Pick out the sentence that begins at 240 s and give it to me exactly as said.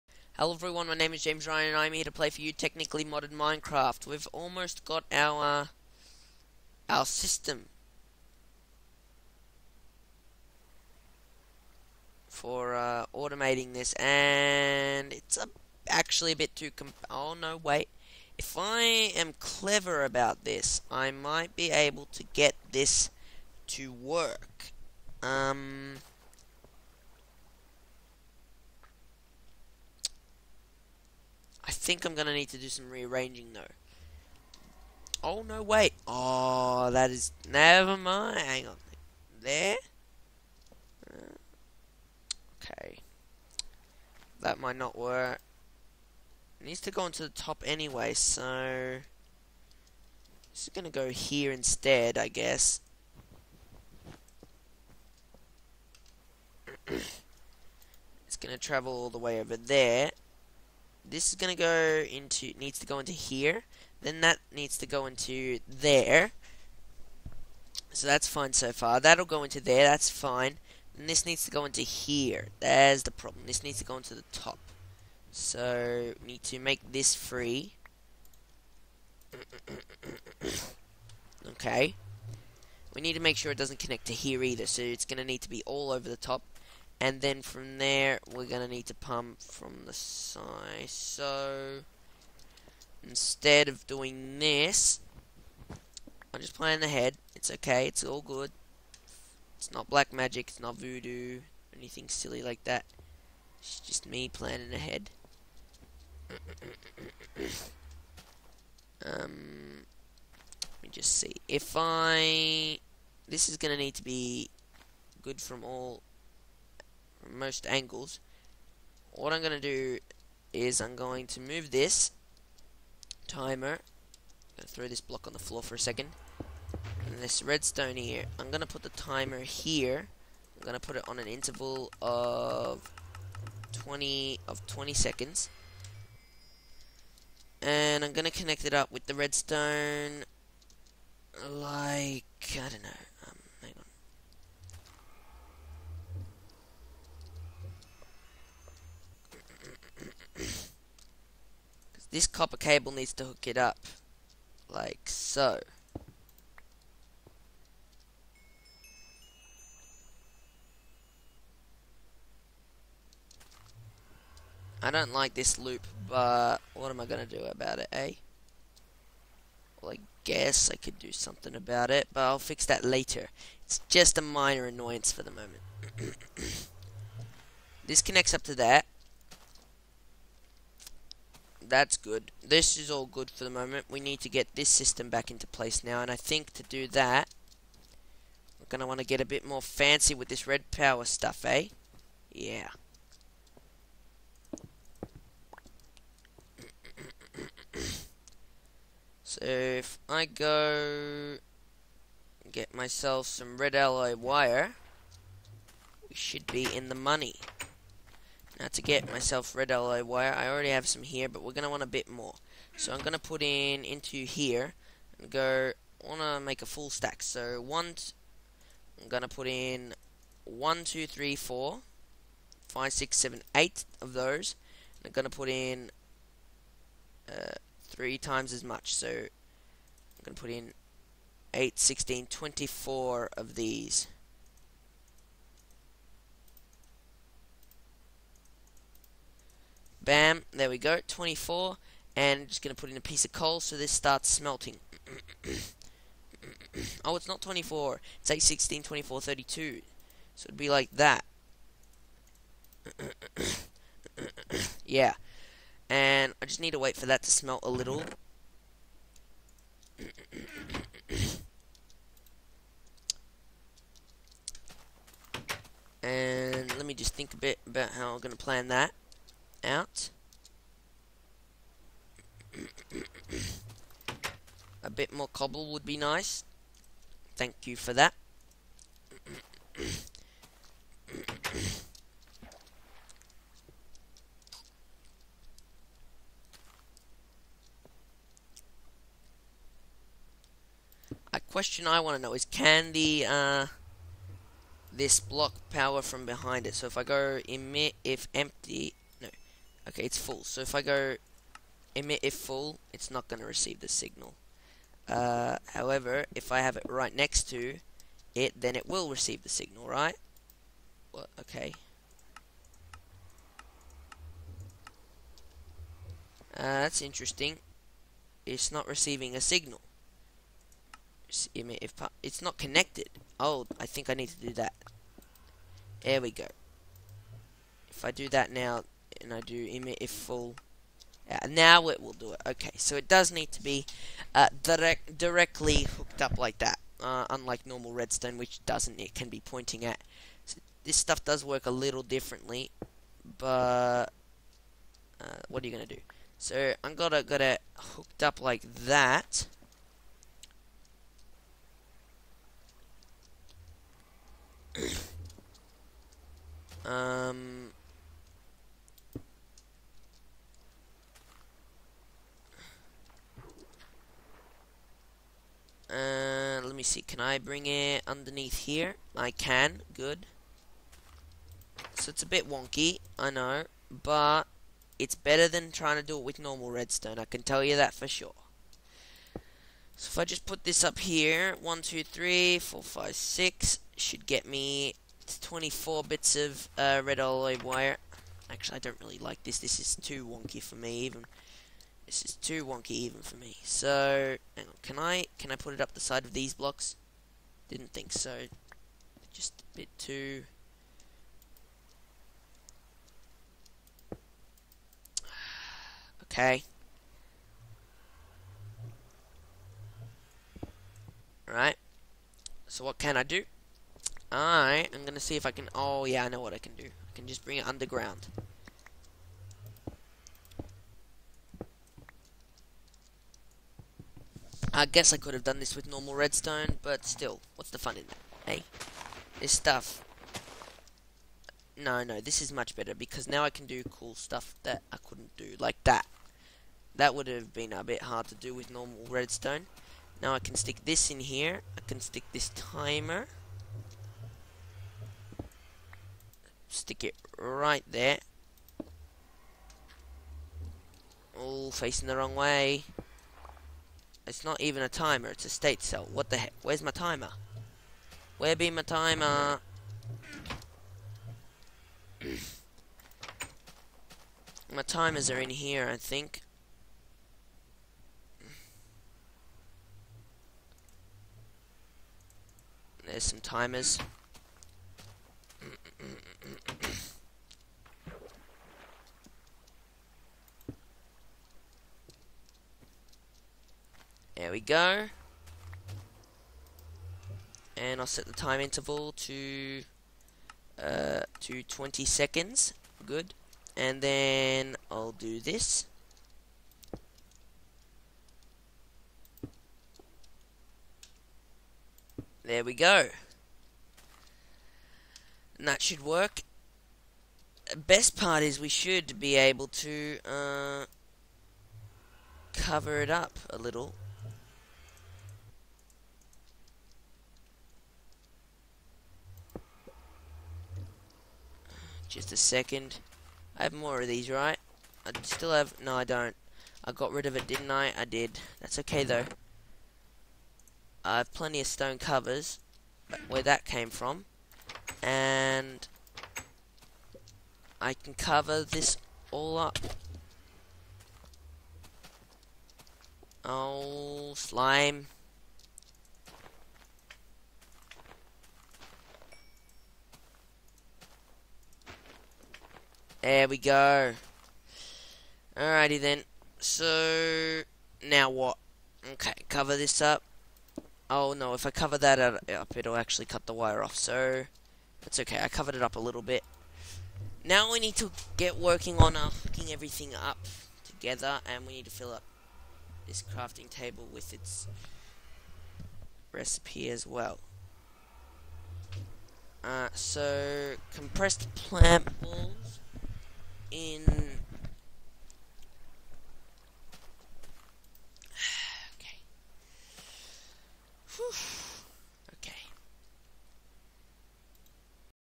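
Bam, there we go, 24, and just going to put in a piece of coal so this starts smelting.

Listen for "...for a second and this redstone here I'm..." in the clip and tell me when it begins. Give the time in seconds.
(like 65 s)
125 s.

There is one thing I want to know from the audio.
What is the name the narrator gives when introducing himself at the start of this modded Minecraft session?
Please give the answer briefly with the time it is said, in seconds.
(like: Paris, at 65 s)
James Ryan, at 1 s.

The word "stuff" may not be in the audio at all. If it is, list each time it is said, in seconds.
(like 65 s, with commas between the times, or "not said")
191 s, 340 s, 429 s, 434 s.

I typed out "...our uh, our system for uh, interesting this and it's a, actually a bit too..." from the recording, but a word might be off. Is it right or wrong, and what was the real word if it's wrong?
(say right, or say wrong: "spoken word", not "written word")
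wrong: "automating", not "interesting".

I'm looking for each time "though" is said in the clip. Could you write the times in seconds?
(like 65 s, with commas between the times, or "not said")
33 s, 529 s.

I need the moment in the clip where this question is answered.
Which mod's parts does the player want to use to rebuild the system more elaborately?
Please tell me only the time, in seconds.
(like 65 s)
190 s.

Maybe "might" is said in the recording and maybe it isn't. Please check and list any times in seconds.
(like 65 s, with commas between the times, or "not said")
21 s, 44 s.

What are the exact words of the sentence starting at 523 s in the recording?
I have more of these, right?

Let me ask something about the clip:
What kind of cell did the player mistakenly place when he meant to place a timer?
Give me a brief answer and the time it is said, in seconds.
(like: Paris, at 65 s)
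state cell, at 455 s.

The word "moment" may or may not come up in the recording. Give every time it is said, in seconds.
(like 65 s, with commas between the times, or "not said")
175 s, 183 s.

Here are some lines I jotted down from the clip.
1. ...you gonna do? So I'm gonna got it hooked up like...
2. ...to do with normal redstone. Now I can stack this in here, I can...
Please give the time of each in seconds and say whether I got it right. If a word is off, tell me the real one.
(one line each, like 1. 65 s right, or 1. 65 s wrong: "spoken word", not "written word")
1. 345 s right
2. 438 s wrong: "stick", not "stack".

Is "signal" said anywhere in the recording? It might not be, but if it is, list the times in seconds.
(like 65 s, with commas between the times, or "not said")
303 s, 309 s, 319 s.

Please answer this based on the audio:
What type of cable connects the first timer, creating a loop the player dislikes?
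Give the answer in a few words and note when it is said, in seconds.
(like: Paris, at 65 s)
copper cable, at 152 s.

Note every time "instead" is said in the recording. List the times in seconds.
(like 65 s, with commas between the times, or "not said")
51 s, 93 s.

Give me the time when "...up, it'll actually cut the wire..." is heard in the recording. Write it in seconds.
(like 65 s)
562 s.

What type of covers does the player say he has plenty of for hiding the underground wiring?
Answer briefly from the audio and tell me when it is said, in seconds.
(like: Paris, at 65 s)
stone covers, at 531 s.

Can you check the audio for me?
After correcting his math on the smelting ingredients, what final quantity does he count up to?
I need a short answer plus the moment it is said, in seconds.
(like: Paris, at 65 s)
32, at 249 s.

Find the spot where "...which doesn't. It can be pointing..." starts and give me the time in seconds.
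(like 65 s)
338 s.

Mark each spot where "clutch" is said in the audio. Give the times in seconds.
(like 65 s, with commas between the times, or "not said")
not said.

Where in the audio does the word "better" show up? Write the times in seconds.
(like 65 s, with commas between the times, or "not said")
375 s, 432 s.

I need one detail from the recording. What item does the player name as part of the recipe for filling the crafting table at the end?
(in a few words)
compressed plant balls.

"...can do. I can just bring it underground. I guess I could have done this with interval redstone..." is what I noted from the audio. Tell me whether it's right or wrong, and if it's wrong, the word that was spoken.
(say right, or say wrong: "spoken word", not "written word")
wrong: "normal", not "interval".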